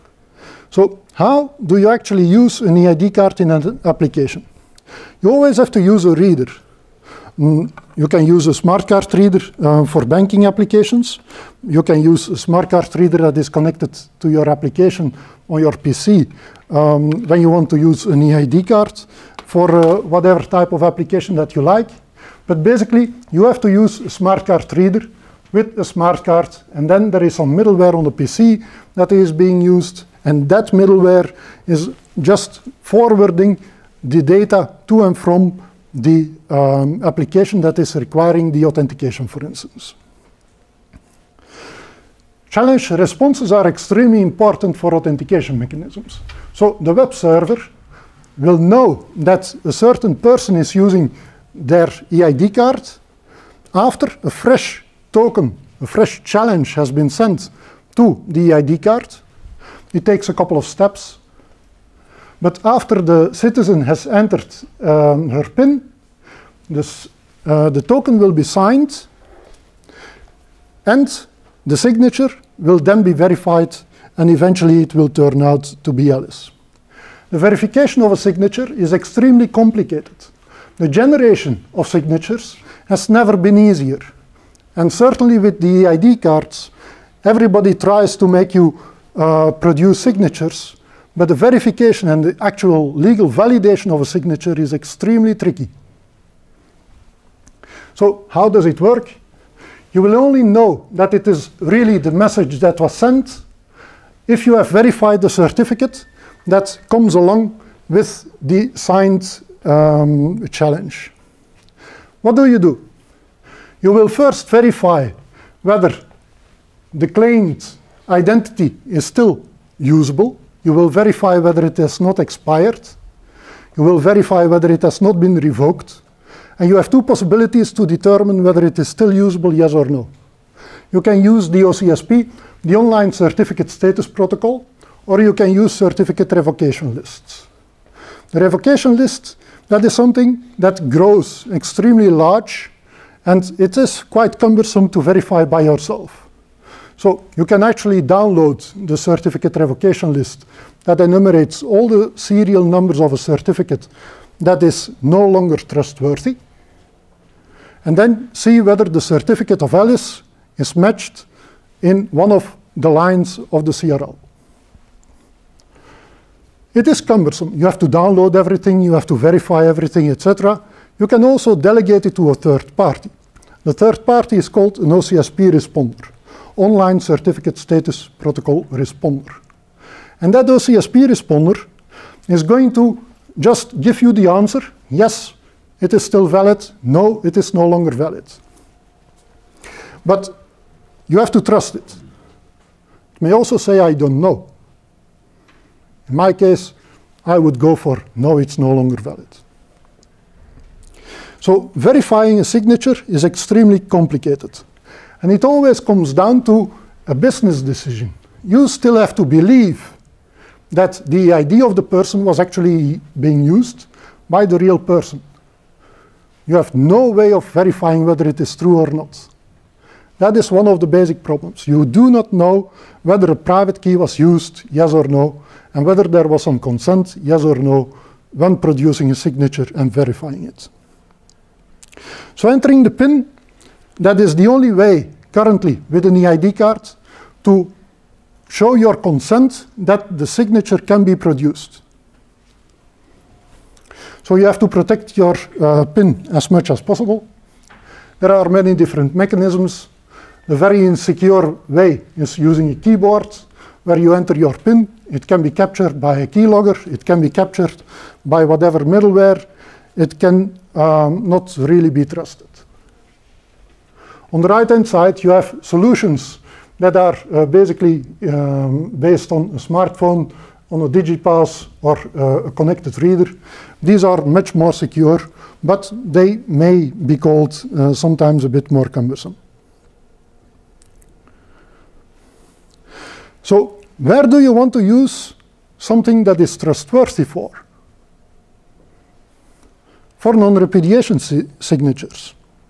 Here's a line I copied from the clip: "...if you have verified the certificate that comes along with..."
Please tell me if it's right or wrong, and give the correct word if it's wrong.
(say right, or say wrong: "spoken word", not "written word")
right.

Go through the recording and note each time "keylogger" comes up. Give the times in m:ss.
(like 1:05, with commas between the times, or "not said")
4:16.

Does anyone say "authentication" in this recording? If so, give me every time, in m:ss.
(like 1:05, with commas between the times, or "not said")
0:38, 0:44.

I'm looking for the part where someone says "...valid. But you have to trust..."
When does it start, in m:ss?
3:07.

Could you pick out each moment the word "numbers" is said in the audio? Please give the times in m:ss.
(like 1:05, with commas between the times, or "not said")
2:32.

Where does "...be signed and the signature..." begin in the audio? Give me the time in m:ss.
1:08.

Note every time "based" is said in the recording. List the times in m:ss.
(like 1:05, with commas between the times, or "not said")
4:28.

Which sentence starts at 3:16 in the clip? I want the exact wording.
In my case, I would go for, no, it's no longer valid.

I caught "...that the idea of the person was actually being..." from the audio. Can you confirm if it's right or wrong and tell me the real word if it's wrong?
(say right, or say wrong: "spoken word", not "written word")
right.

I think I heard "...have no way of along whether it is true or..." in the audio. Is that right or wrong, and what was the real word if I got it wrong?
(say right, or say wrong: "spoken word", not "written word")
wrong: "verifying", not "along".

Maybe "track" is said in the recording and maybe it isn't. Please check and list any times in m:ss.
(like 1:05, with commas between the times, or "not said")
not said.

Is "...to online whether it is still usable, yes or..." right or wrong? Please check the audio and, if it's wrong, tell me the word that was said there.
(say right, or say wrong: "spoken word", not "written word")
wrong: "determine", not "online".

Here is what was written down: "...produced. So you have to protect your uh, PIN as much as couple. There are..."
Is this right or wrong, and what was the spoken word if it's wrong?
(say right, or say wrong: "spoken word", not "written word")
wrong: "possible", not "couple".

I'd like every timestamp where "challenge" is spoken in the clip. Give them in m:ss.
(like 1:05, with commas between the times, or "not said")
0:42, 0:56, 1:50.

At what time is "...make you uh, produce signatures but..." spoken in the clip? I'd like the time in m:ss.
1:28.